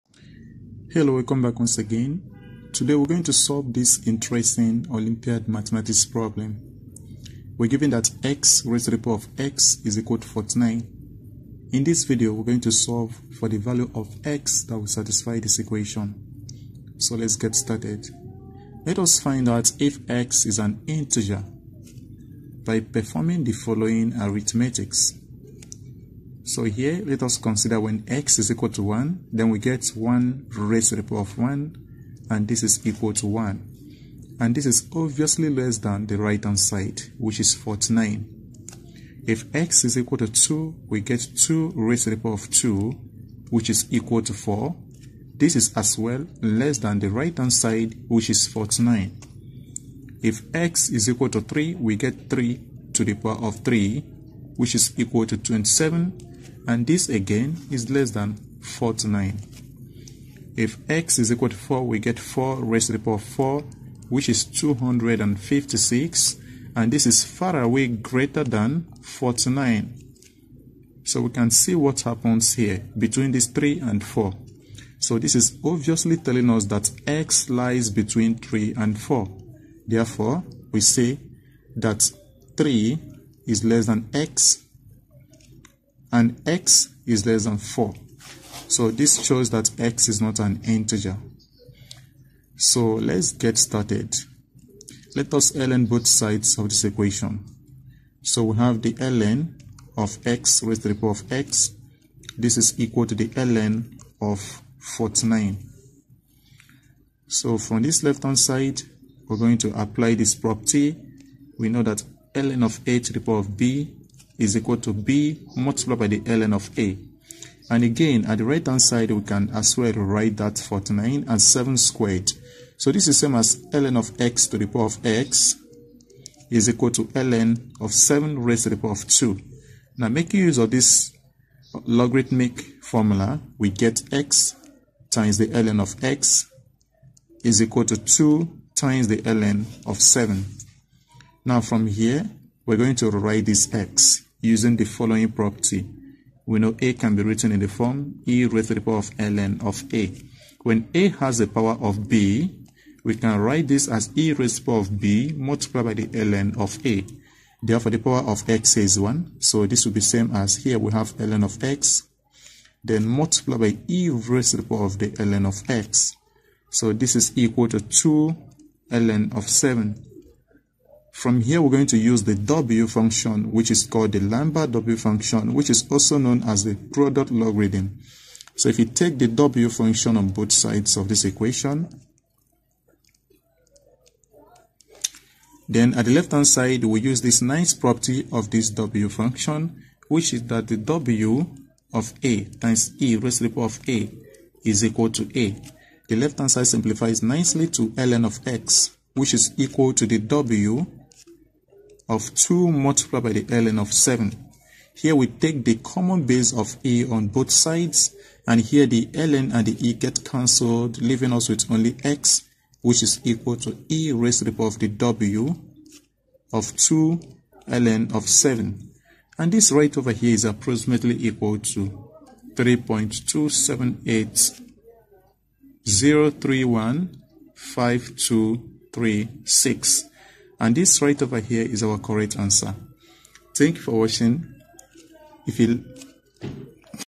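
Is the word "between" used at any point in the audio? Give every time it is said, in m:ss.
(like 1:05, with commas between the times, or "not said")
1:12, 1:17.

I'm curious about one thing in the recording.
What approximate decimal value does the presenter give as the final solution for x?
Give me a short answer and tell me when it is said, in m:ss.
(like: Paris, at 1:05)
3.2780315236, at 3:42.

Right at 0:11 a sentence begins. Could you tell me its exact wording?
In this video, we're going to solve for the value of x that will satisfy this equation.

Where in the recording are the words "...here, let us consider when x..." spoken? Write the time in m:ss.
0:26.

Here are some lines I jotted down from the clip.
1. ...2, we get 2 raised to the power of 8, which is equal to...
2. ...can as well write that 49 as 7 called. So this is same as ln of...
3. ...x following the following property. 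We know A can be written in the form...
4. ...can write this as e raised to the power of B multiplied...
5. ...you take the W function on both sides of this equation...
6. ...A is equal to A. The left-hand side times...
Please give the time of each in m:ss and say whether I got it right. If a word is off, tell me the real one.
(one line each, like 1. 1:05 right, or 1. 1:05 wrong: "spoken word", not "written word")
1. 0:40 wrong: "2", not "8"
2. 1:59 wrong: "squared", not "called"
3. 2:23 wrong: "using", not "following"
4. 2:33 right
5. 2:58 right
6. 3:13 wrong: "simplifies", not "times".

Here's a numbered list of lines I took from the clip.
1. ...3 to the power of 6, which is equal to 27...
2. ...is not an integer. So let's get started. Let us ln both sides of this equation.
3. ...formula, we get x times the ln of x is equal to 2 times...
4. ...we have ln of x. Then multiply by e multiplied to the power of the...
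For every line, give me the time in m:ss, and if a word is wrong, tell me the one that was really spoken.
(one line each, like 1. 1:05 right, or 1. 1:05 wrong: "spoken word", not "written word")
1. 0:52 wrong: "3", not "6"
2. 1:30 right
3. 2:12 right
4. 2:40 wrong: "raised", not "multiplied".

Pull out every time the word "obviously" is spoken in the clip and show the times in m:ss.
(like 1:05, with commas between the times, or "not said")
0:34, 1:15.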